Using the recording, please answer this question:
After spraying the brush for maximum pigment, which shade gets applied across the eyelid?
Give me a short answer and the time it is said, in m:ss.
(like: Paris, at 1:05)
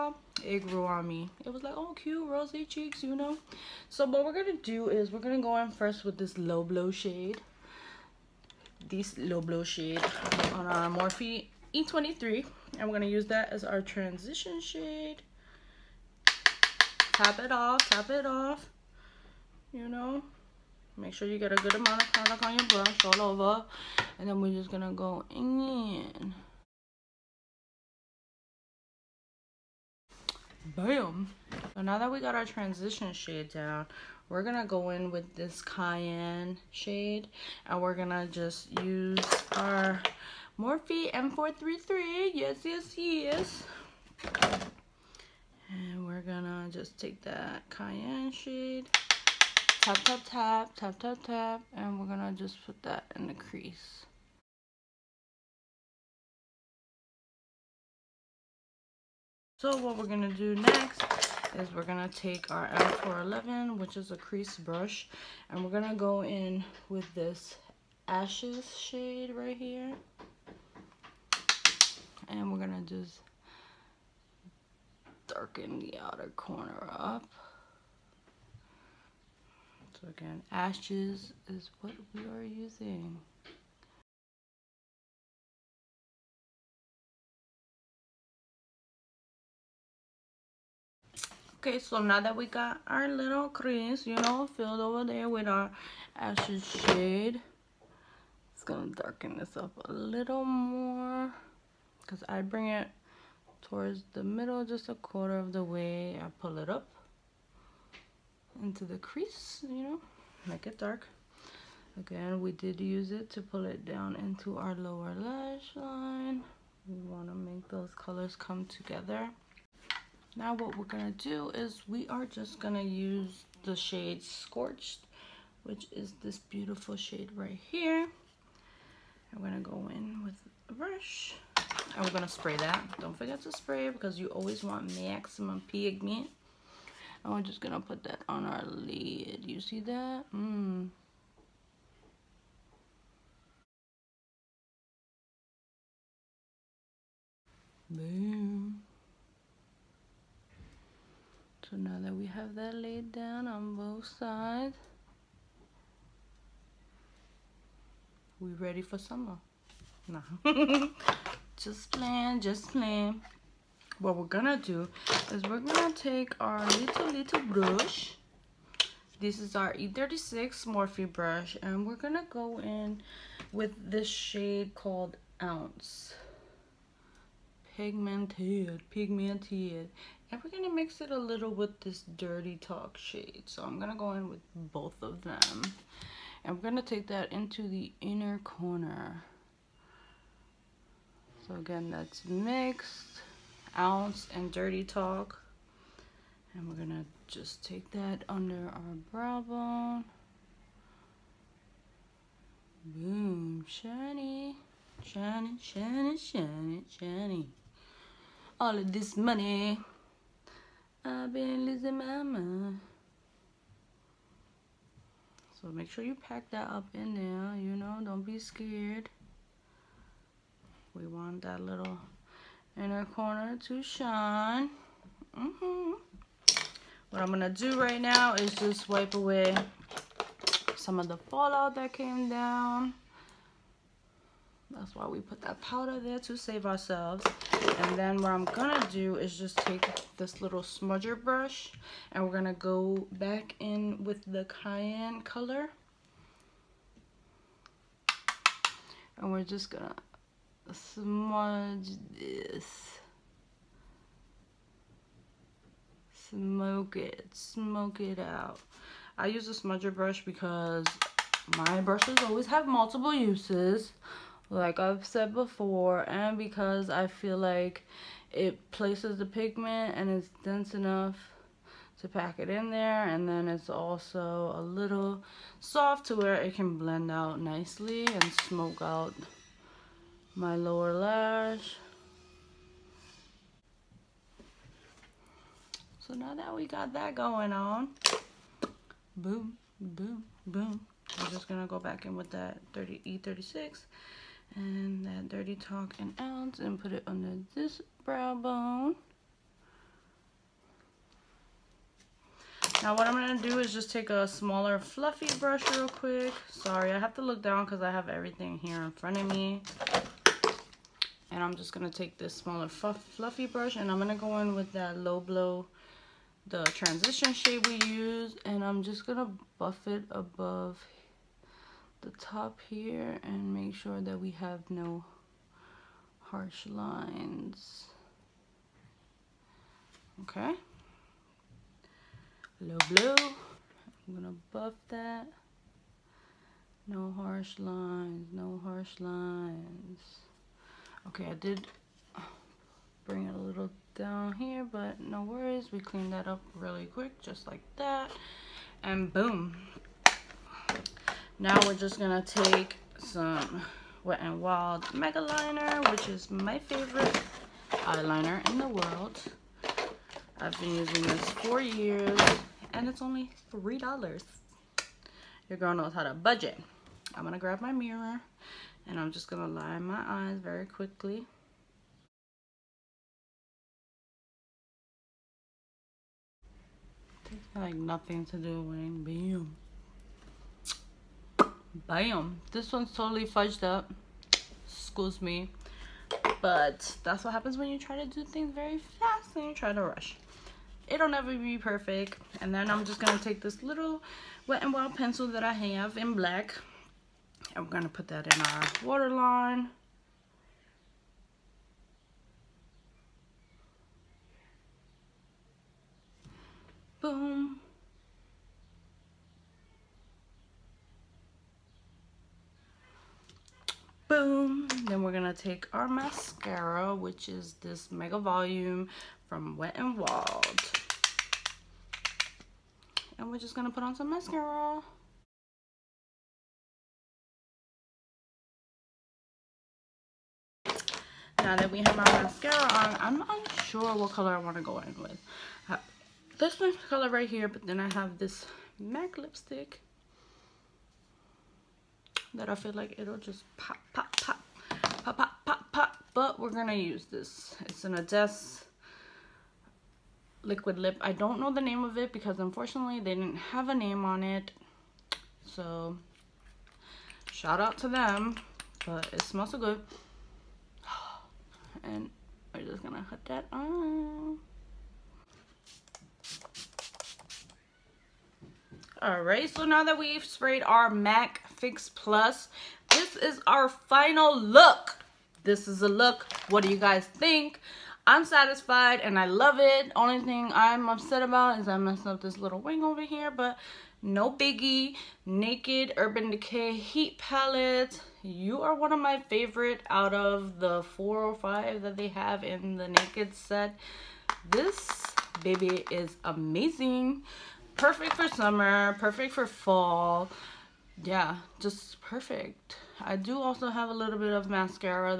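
Scorched, at 2:04.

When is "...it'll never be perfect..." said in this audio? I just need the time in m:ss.
6:30.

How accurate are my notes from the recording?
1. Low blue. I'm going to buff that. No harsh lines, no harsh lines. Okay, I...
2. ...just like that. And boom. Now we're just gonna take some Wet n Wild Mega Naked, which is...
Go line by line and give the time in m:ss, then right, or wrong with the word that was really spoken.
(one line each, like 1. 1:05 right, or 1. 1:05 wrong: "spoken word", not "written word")
1. 5:32 right
2. 5:47 wrong: "Liner", not "Naked".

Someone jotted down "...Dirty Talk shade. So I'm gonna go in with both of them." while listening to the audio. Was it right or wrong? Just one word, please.
right.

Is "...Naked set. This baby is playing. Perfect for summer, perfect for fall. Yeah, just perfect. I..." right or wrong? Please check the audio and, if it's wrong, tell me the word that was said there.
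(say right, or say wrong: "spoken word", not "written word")
wrong: "amazing", not "playing".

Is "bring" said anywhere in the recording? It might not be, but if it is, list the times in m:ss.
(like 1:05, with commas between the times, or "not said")
1:42, 5:43.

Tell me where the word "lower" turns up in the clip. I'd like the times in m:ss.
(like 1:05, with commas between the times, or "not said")
1:54, 4:40.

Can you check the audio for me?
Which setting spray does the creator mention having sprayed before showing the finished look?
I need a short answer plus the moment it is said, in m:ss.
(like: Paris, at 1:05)
MAC Fix Plus, at 7:50.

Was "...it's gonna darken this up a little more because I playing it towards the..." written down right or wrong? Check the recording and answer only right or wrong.
wrong.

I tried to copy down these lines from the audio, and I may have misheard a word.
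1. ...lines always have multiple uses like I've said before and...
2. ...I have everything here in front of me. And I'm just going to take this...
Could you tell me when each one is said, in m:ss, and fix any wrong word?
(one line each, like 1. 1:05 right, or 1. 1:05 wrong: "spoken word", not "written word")
1. 4:21 wrong: "brushes", not "lines"
2. 5:07 right.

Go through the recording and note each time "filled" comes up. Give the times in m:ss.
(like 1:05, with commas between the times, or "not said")
1:34.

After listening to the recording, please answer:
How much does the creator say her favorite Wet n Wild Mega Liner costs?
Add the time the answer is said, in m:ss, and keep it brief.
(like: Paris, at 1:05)
$3, at 6:03.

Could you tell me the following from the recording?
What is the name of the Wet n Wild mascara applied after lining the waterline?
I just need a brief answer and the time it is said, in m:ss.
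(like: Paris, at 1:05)
Mega Volume, at 6:57.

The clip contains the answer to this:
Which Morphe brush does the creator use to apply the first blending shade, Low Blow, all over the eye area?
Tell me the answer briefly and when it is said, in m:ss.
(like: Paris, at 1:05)
E23, at 0:11.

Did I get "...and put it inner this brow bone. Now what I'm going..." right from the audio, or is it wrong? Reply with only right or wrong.
wrong.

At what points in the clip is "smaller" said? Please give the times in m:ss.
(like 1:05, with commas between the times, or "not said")
5:04, 5:12.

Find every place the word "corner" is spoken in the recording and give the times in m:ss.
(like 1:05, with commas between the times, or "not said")
1:16, 3:08, 3:43.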